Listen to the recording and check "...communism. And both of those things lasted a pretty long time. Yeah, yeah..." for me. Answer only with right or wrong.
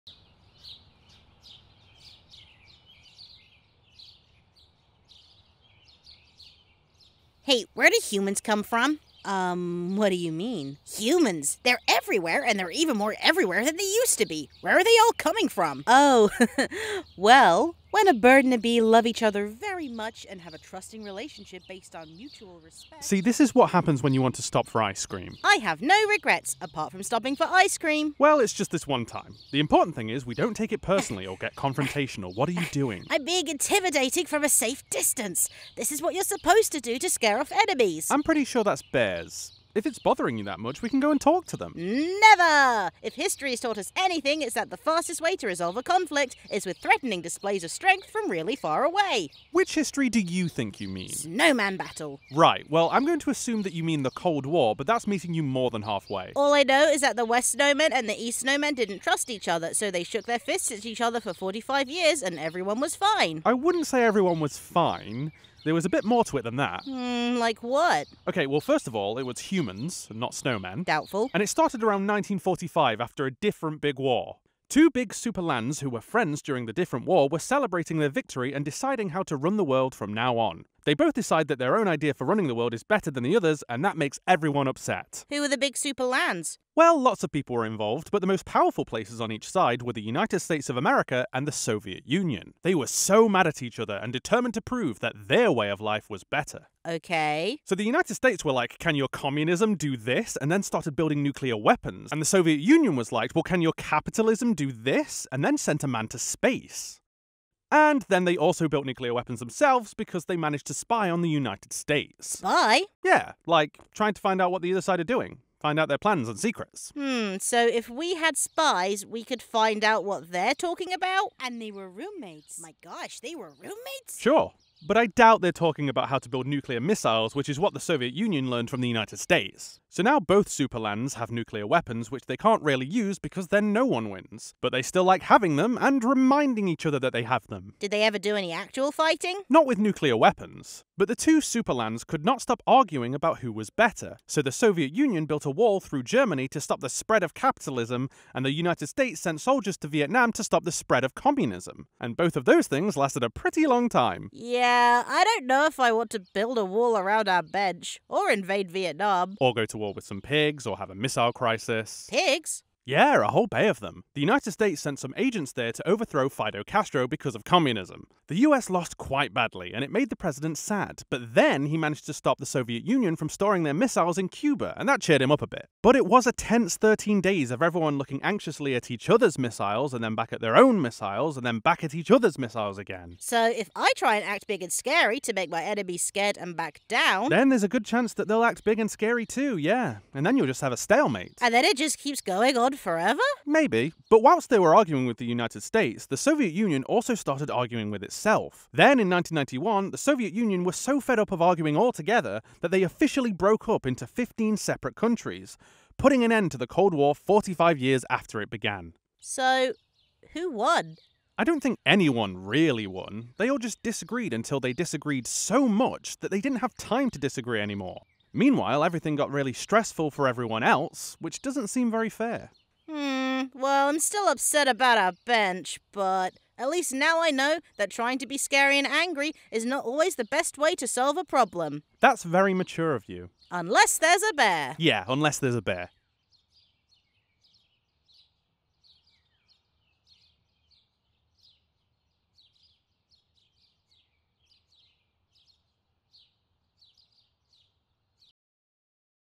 right.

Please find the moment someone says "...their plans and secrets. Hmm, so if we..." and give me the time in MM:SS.
01:55.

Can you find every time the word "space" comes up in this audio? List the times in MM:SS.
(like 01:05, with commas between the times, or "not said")
01:46.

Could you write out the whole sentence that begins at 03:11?
And then it just keeps going on forever?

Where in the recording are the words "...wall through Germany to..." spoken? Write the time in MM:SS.
02:25.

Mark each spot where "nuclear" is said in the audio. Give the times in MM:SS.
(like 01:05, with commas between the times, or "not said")
01:41, 01:48, 02:06, 02:11, 02:19.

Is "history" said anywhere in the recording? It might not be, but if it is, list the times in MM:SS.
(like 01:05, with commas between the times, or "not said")
00:43, 00:49.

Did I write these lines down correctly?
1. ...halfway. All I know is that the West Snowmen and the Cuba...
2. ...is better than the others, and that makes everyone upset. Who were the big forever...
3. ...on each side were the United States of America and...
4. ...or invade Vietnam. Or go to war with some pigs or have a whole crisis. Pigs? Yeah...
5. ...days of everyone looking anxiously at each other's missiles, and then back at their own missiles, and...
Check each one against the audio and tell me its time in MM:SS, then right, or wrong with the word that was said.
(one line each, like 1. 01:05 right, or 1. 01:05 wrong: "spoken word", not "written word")
1. 00:55 wrong: "East", not "Cuba"
2. 01:22 wrong: "super", not "forever"
3. 01:29 right
4. 02:38 wrong: "missile", not "whole"
5. 02:57 right.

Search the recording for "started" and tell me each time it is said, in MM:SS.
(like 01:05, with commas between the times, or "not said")
01:11, 01:40, 03:17.